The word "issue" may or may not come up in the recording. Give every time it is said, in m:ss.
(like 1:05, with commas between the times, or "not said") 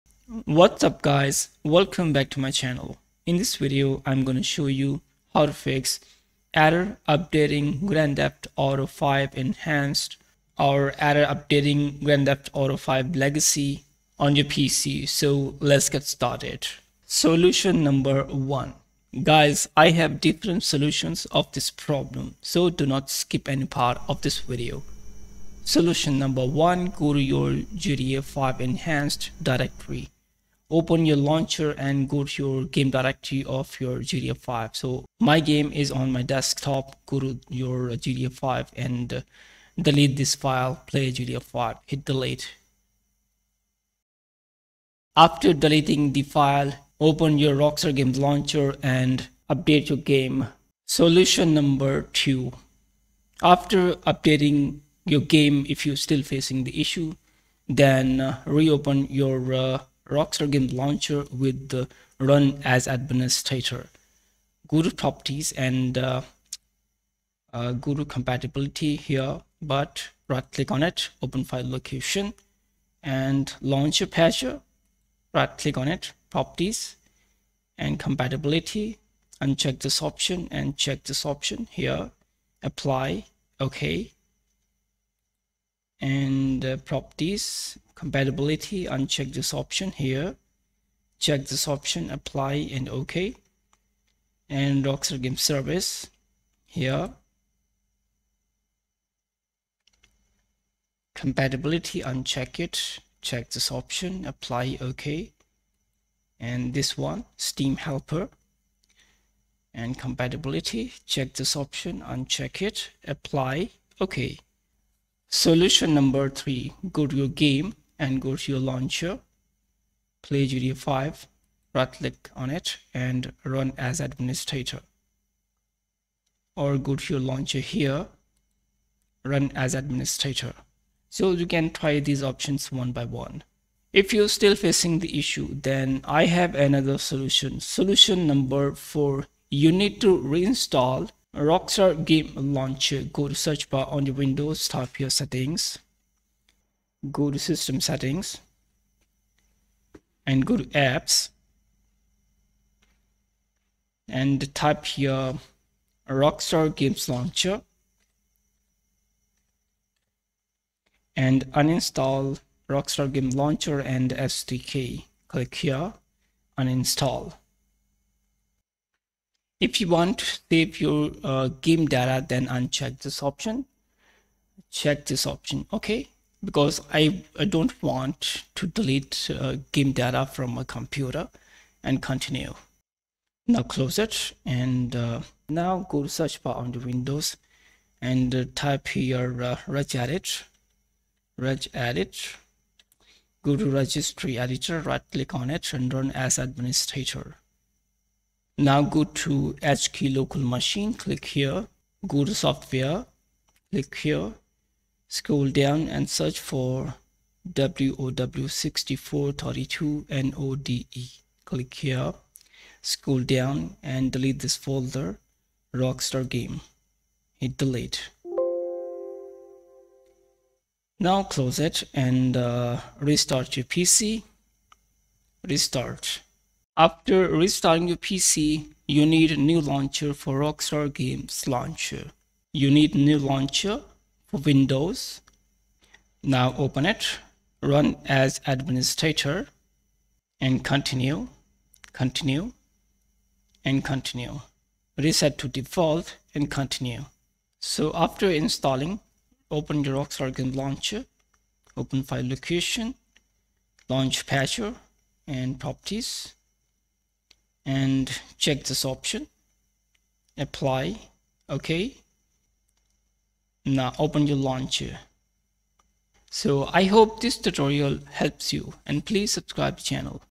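0:56, 2:15.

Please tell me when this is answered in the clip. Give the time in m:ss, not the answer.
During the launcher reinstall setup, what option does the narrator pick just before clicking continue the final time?
4:04.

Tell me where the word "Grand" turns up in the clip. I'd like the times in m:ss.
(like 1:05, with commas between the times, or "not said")
0:07, 0:12.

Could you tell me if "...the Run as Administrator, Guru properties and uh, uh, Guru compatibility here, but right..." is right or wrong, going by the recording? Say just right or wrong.
right.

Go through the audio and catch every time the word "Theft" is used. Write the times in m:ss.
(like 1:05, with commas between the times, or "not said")
0:08, 0:12.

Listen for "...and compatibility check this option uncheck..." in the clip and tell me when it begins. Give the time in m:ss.
1:49.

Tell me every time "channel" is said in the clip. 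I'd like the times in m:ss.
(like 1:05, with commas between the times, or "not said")
0:02, 4:29.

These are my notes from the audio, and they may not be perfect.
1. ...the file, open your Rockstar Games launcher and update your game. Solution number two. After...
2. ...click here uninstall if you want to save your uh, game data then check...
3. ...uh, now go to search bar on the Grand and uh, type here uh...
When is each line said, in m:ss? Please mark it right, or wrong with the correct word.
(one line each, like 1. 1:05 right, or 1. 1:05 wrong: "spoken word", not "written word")
1. 0:46 right
2. 2:45 wrong: "uncheck", not "check"
3. 3:04 wrong: "Windows", not "Grand".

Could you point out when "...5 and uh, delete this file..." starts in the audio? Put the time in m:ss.
0:38.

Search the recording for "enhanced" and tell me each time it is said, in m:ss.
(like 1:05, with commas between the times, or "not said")
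0:09, 0:28.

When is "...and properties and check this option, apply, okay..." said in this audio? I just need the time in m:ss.
4:15.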